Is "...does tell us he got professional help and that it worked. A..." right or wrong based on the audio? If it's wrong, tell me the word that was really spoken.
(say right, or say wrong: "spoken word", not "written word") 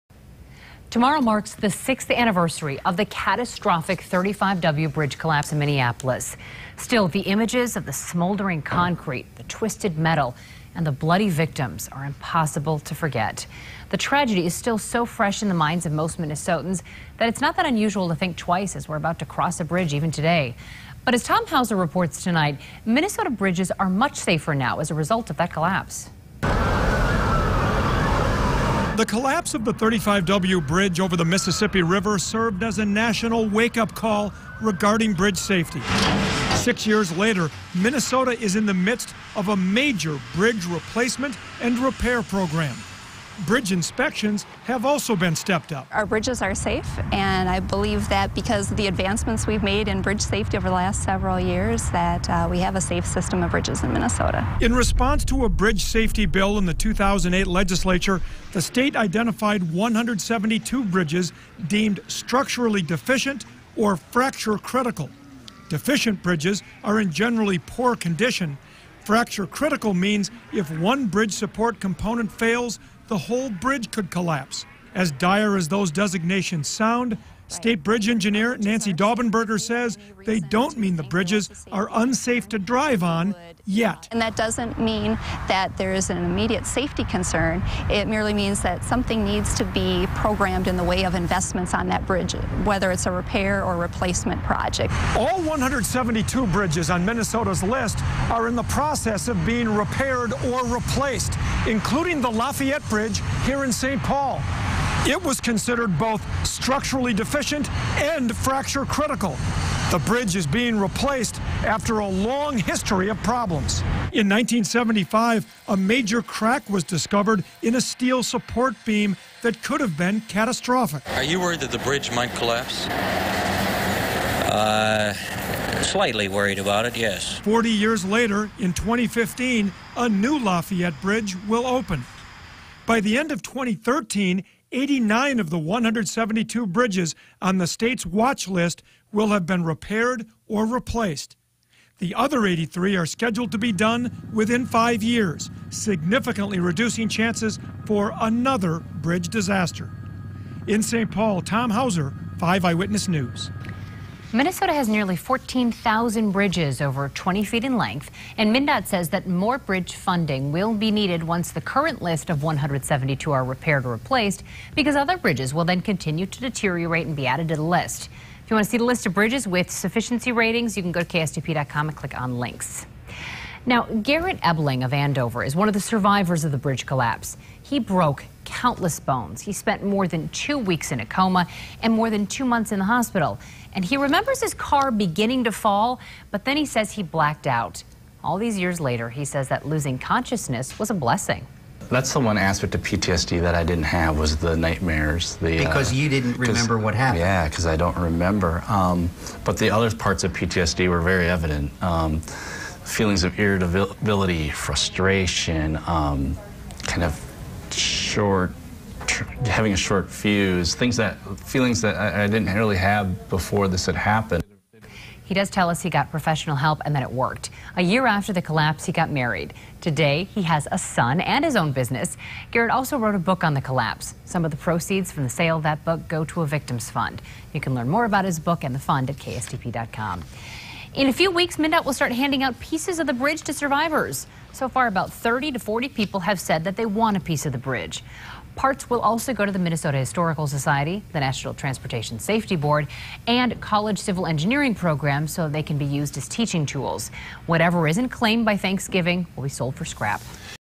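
right.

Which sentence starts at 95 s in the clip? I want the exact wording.
All 172 bridges on Minnesota's list are in the process of being repaired or replaced, including the Lafayette Bridge here in St.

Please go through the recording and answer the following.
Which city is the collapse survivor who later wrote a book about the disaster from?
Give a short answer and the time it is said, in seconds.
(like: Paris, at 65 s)
Andover, at 174 s.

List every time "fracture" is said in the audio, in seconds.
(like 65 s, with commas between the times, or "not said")
63 s, 69 s, 108 s.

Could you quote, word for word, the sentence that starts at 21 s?
But as Tom Hauser reports tonight, Minnesota bridges are much safer now as a result of that collapse.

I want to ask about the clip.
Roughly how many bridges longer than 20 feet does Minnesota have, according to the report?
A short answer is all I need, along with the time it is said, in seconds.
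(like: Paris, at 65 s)
14,000, at 155 s.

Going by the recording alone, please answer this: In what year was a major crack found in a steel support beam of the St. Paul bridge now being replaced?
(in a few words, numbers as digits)
1975.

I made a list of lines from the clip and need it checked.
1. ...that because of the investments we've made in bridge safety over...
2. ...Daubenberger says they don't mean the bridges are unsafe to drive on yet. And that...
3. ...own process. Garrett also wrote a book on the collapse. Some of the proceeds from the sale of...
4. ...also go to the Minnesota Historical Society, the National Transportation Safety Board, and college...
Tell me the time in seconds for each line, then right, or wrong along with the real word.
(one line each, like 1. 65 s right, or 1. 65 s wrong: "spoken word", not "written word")
1. 48 s wrong: "advancements", not "investments"
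2. 78 s right
3. 221 s wrong: "business", not "process"
4. 238 s right.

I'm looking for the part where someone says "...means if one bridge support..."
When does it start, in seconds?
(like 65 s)
69 s.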